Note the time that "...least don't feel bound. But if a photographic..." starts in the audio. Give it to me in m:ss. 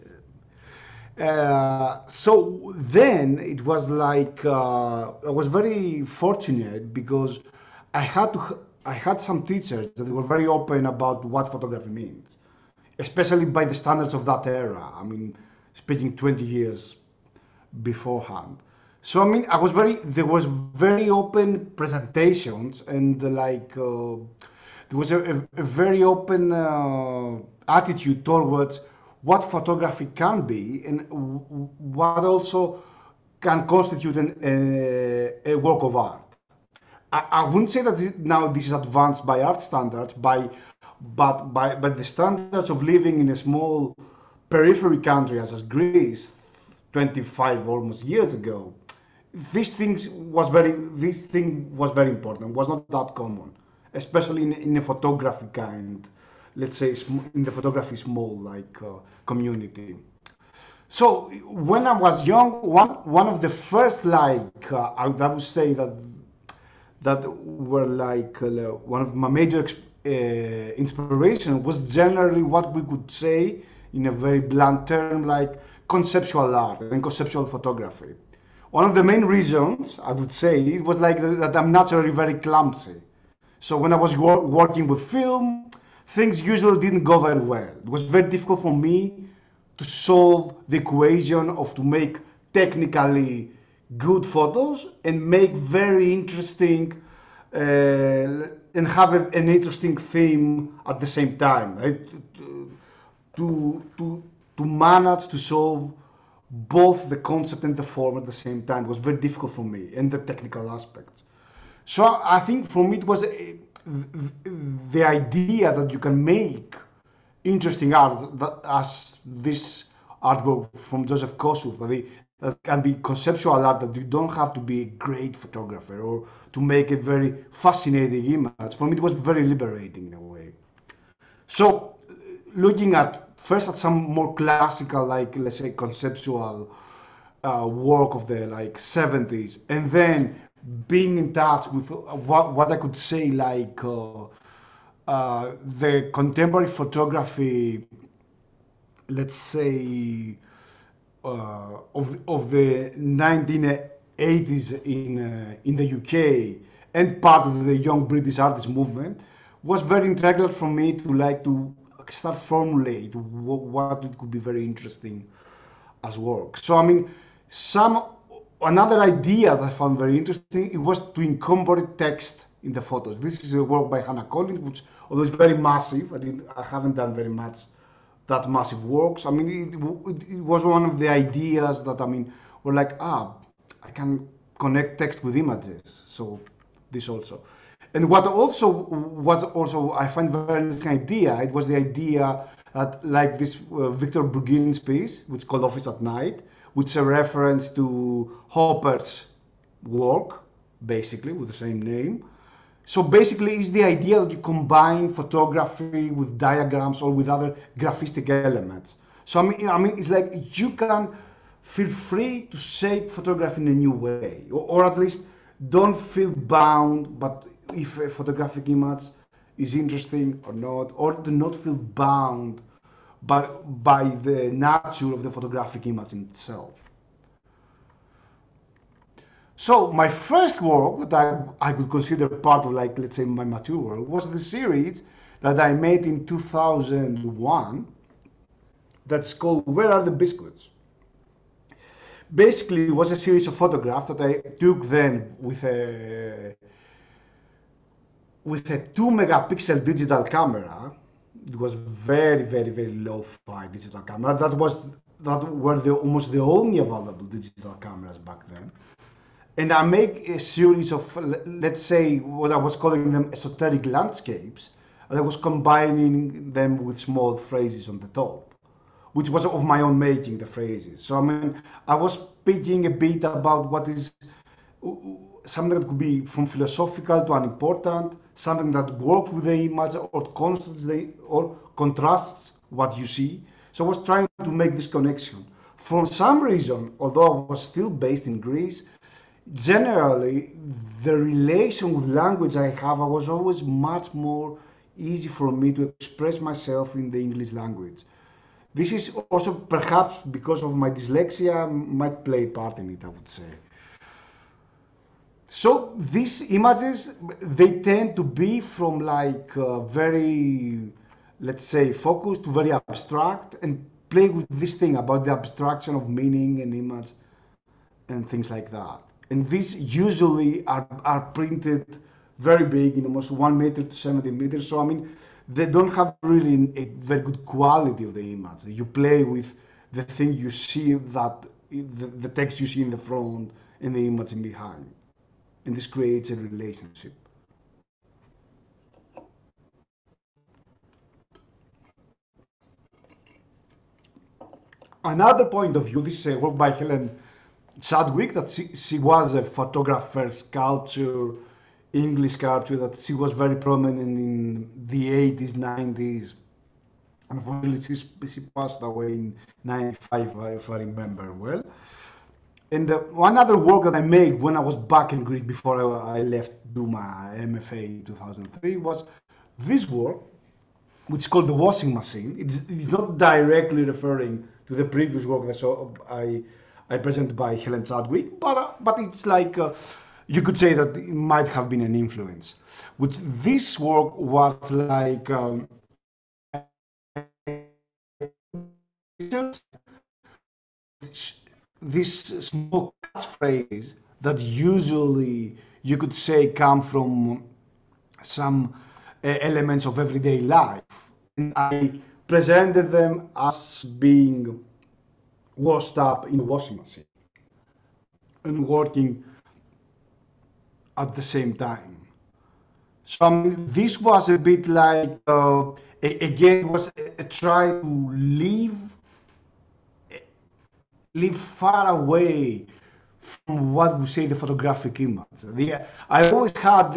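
3:34.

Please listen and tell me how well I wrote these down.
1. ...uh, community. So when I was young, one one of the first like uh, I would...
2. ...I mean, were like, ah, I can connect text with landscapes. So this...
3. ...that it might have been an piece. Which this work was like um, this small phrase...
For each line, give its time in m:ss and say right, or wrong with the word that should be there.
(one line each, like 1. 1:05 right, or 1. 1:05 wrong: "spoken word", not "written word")
1. 0:58 right
2. 3:02 wrong: "images", not "landscapes"
3. 6:20 wrong: "influence", not "piece".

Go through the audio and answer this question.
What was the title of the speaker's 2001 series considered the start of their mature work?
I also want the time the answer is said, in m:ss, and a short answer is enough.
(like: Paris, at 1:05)
Where Are the Biscuits?, at 3:59.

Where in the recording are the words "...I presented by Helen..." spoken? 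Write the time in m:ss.
6:16.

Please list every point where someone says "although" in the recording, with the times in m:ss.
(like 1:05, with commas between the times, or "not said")
2:55, 4:46.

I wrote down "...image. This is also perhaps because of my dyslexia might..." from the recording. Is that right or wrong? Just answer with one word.
wrong.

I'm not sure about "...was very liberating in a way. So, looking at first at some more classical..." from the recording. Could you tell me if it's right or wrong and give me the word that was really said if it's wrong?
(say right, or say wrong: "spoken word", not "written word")
right.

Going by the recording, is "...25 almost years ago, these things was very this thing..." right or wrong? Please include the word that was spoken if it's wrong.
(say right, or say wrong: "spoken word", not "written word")
right.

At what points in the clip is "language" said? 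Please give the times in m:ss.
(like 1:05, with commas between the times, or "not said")
4:52, 4:57.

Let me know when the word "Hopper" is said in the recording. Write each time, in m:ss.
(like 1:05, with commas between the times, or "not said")
3:18.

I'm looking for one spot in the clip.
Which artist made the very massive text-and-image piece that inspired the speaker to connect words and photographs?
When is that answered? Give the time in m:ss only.
2:54.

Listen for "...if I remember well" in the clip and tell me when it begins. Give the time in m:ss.
6:00.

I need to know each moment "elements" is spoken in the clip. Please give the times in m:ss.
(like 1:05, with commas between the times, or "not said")
3:28, 6:39.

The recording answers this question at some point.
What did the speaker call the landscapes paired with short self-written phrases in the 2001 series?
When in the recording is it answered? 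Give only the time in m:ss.
4:23.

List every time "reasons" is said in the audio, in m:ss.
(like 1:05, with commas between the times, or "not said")
1:19, 4:46.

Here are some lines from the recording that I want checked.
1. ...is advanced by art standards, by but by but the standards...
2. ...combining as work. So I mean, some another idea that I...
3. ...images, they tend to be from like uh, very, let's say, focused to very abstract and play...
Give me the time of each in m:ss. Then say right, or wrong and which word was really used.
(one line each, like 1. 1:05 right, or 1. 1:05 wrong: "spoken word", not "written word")
1. 0:38 right
2. 2:44 wrong: "interesting", not "combining"
3. 5:06 right.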